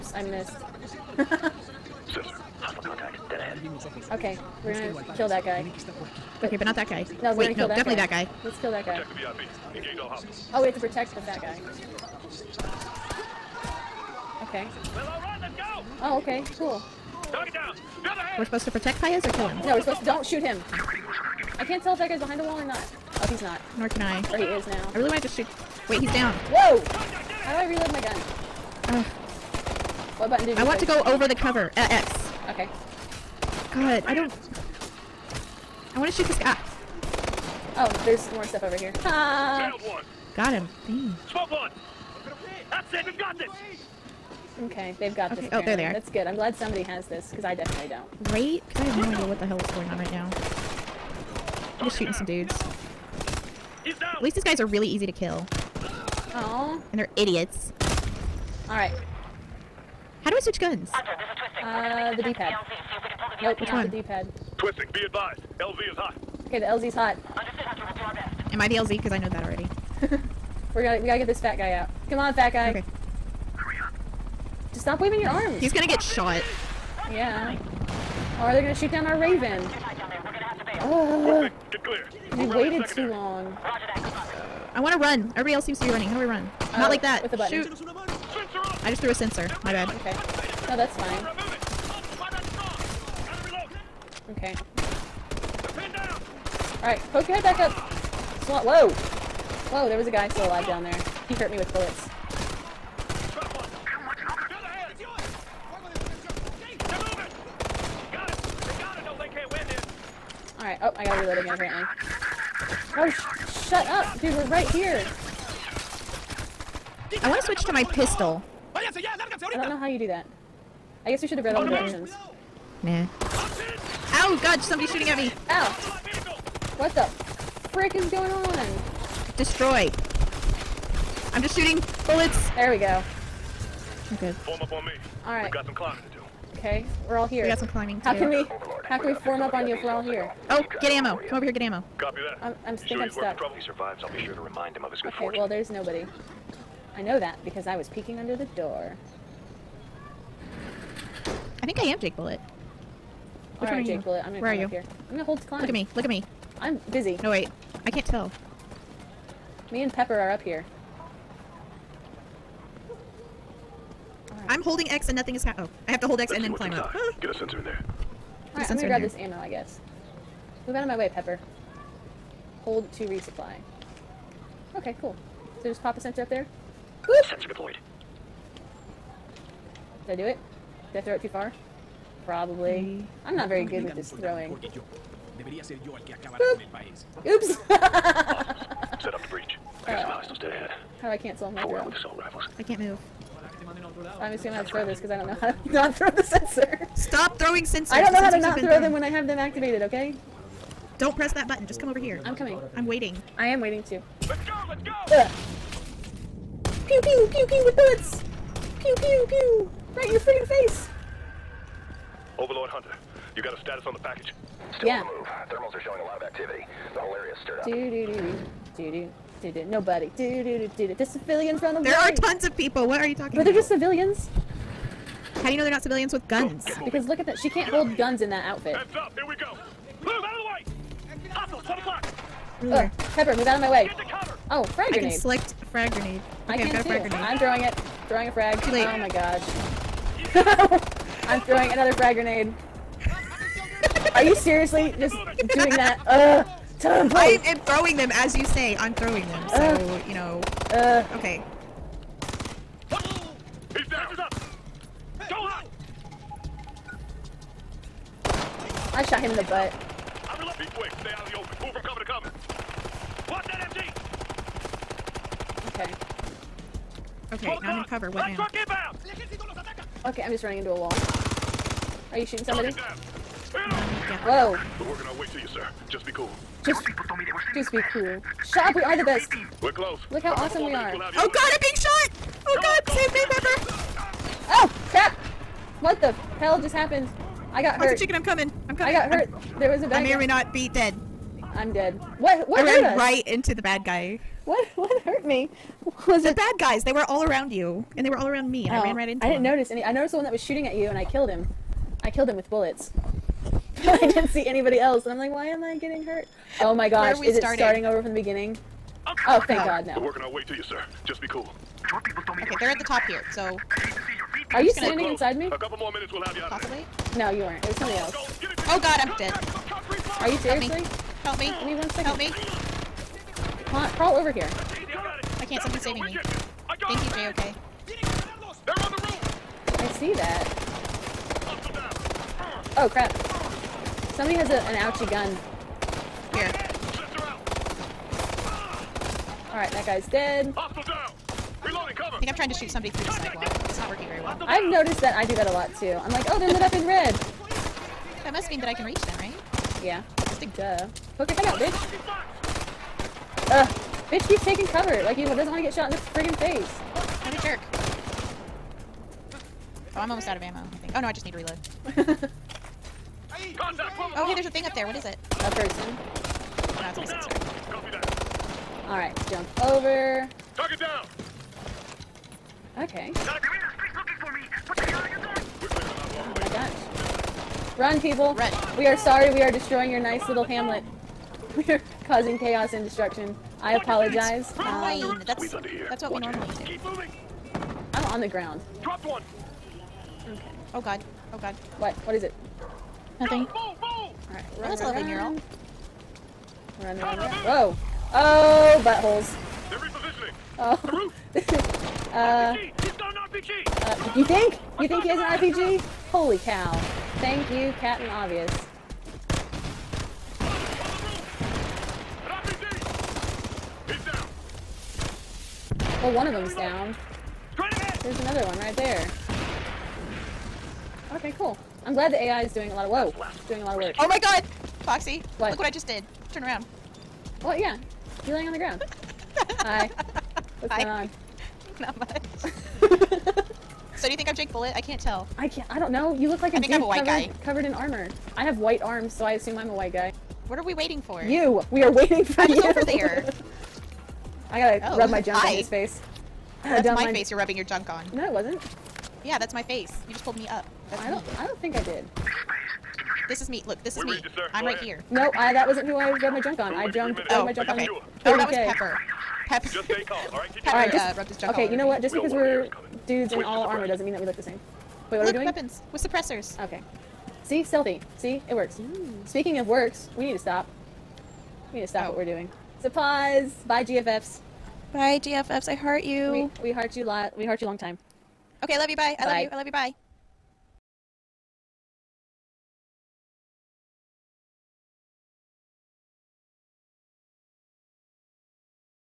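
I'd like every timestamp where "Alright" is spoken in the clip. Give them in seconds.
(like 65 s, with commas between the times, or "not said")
58 s, 96 s, 168 s, 339 s, 368 s, 393 s.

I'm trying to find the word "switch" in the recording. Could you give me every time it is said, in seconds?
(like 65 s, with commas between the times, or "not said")
60 s, 117 s.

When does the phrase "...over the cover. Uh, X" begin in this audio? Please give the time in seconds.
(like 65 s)
31 s.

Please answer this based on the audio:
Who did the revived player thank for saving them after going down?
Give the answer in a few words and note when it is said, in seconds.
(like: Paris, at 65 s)
JOK, at 326 s.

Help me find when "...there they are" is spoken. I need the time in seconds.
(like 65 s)
45 s.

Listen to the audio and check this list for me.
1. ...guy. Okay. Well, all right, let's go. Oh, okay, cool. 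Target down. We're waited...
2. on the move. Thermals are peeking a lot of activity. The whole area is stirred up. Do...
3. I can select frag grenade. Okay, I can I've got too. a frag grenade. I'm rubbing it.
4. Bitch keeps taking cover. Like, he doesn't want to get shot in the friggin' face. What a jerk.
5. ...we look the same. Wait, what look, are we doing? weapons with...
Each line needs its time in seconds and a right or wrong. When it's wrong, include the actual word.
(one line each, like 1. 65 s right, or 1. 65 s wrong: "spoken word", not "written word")
1. 11 s wrong: "supposed", not "waited"
2. 215 s wrong: "showing", not "peeking"
3. 235 s wrong: "throwing", not "rubbing"
4. 354 s right
5. 464 s right.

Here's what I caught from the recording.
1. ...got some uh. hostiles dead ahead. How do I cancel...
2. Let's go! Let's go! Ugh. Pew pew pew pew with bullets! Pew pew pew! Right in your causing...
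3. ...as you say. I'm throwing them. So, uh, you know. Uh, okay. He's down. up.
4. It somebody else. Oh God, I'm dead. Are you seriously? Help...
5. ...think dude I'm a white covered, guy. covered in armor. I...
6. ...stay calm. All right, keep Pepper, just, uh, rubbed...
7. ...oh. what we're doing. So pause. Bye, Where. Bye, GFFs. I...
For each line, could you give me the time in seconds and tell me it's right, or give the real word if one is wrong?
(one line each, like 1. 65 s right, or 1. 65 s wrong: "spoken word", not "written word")
1. 189 s right
2. 204 s wrong: "freaking", not "causing"
3. 248 s right
4. 317 s right
5. 436 s right
6. 459 s right
7. 472 s wrong: "GFFs", not "Where".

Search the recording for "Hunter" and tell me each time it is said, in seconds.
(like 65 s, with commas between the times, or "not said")
67 s, 212 s.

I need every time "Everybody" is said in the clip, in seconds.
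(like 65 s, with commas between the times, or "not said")
85 s.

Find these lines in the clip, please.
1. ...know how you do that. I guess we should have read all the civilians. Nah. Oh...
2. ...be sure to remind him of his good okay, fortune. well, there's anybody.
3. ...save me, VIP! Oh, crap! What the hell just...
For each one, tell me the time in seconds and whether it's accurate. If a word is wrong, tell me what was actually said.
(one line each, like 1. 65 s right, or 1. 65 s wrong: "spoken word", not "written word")
1. 119 s wrong: "directions", not "civilians"
2. 144 s wrong: "nobody", not "anybody"
3. 282 s wrong: "Pepper", not "VIP".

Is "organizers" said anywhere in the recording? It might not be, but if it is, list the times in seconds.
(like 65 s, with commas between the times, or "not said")
not said.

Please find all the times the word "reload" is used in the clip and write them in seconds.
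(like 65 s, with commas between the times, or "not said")
27 s, 361 s.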